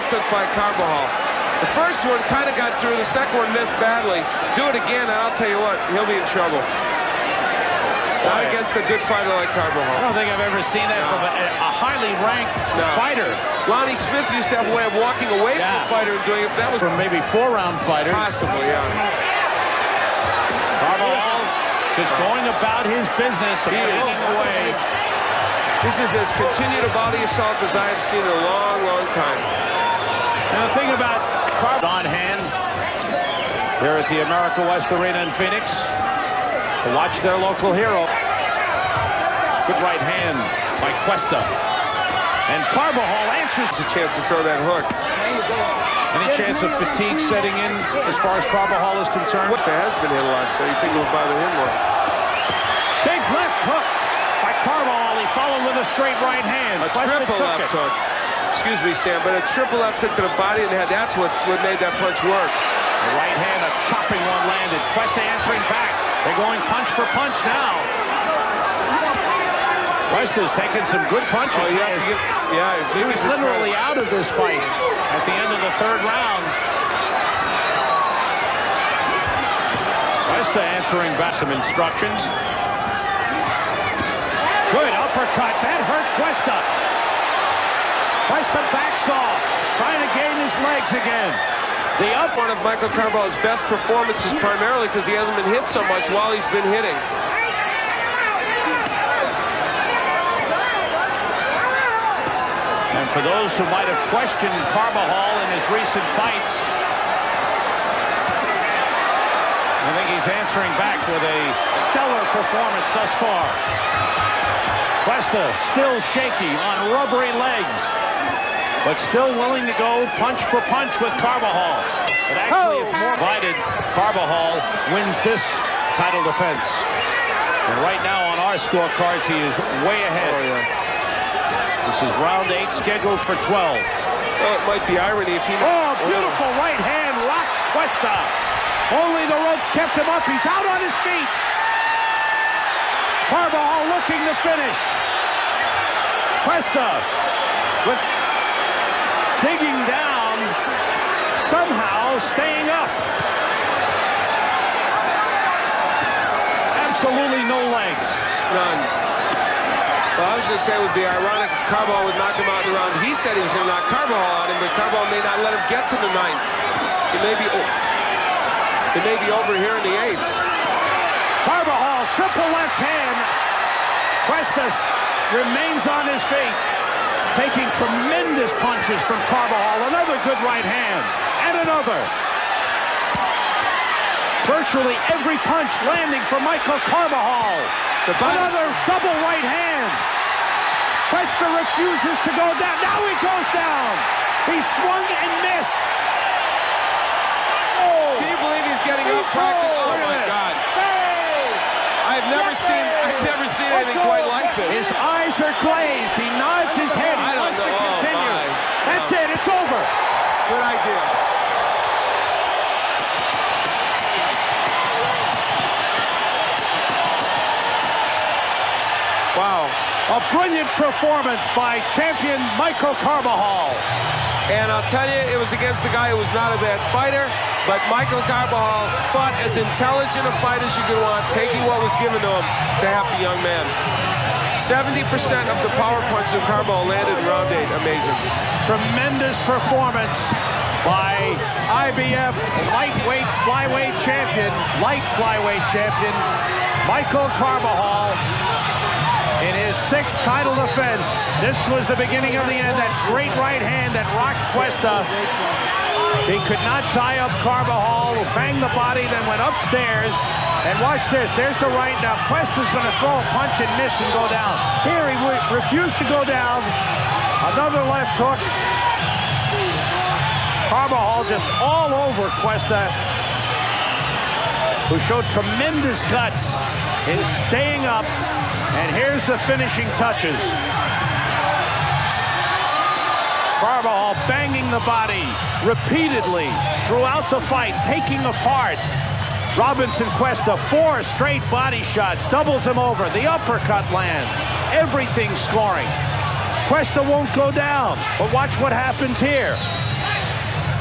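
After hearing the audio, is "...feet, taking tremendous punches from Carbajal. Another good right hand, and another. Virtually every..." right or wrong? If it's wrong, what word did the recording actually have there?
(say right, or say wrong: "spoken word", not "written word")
right.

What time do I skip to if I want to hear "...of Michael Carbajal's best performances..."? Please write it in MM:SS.
01:32.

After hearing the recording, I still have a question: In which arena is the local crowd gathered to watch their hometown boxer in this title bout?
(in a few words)
America West Arena.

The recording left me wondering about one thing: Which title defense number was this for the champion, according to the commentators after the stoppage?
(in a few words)
sixth.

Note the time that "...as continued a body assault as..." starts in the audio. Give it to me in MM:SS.
00:26.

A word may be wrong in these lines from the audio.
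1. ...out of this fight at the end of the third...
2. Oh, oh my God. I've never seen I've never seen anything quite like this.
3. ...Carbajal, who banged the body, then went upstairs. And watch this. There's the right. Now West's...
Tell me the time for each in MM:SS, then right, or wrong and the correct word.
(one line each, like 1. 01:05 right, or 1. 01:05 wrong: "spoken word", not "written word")
1. 01:13 right
2. 03:19 right
3. 04:17 wrong: "Cuesta", not "West".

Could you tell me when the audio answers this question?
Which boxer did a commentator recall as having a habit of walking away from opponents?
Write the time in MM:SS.
00:13.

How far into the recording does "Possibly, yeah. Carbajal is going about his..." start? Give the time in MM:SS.
00:18.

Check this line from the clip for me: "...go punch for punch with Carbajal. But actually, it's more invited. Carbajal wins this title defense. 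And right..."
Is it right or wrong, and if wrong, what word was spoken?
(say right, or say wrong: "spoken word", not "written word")
right.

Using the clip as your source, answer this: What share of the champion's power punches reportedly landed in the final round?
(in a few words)
70%.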